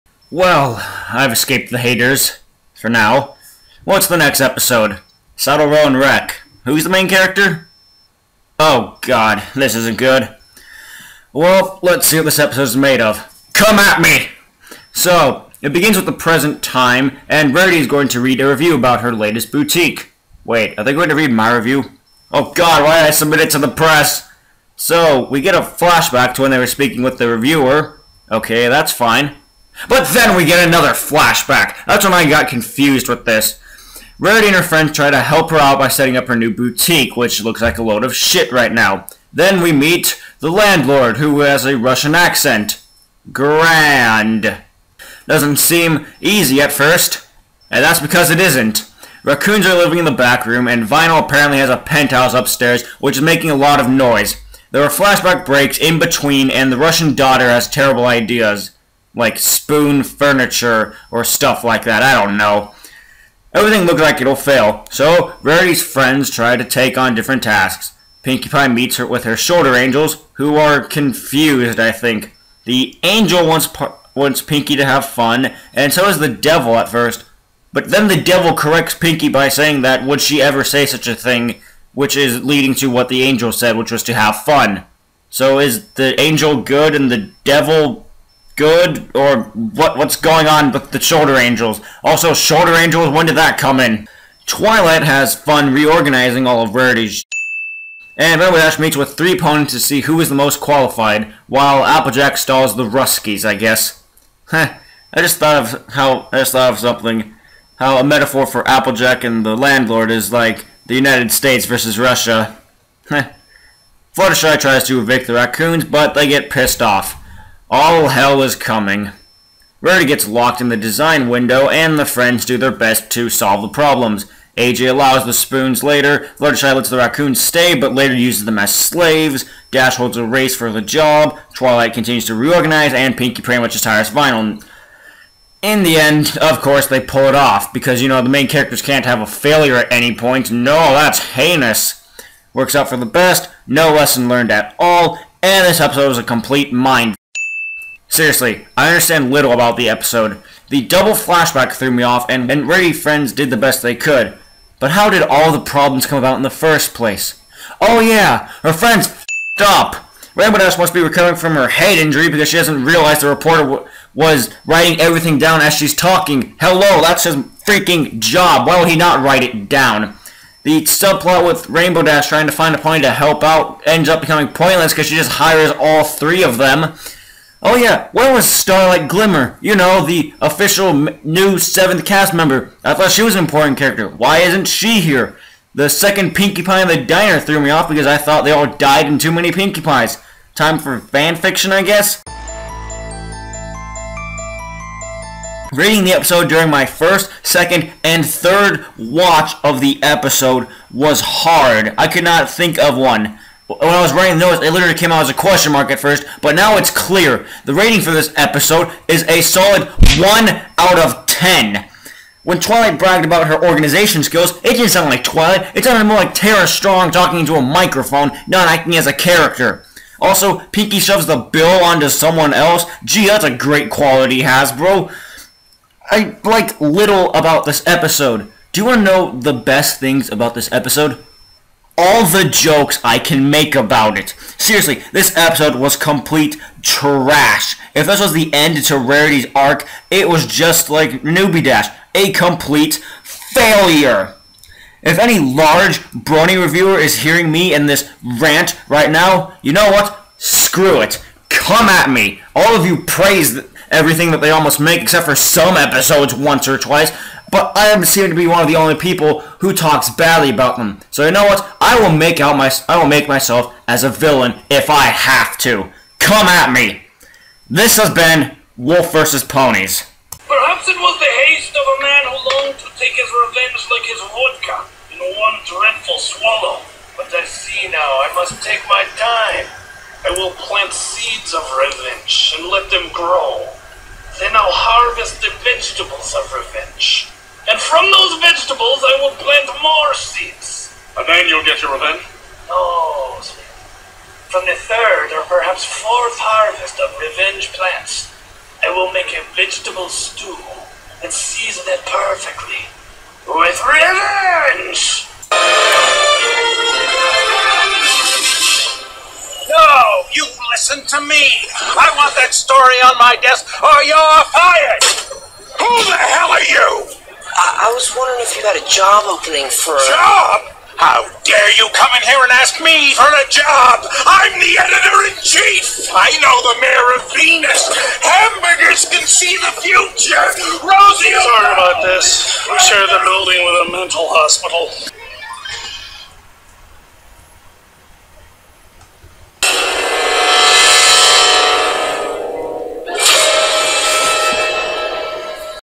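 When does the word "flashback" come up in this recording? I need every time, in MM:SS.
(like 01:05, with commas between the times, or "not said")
00:25, 00:30, 00:54, 02:31.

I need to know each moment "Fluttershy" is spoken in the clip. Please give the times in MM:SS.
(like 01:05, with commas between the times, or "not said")
01:54, 02:06.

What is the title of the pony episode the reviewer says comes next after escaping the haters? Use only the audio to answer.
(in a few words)
Saddle Row and Rec.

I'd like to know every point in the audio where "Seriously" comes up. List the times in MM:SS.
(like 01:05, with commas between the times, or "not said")
02:28, 03:54.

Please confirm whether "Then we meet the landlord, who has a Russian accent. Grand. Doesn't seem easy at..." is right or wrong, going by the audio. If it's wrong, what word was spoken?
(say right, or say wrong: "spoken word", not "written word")
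right.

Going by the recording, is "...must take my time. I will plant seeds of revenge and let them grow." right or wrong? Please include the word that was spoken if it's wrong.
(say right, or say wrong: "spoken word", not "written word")
right.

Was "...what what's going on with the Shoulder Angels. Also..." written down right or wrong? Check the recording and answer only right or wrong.
right.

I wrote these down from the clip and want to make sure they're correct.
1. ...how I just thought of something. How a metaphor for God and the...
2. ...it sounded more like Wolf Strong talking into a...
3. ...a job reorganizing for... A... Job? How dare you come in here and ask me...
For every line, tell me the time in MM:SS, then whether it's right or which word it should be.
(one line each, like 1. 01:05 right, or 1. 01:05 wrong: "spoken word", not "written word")
1. 01:45 wrong: "Applejack", not "God"
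2. 03:35 wrong: "Tara", not "Wolf"
3. 05:18 wrong: "opening", not "reorganizing".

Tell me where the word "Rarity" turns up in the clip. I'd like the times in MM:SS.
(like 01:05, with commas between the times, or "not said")
00:17, 00:34, 01:05, 01:36, 01:59, 03:58.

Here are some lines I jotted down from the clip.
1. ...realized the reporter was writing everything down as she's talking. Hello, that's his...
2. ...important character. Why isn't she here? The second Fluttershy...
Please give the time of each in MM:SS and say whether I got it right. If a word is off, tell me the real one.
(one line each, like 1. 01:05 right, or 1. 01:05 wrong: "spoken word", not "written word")
1. 02:42 right
2. 03:03 wrong: "Pinkie", not "Fluttershy".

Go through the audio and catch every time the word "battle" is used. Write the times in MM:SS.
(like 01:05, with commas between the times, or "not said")
not said.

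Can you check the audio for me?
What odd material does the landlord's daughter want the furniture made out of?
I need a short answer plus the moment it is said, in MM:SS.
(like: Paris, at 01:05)
Spoons, at 00:59.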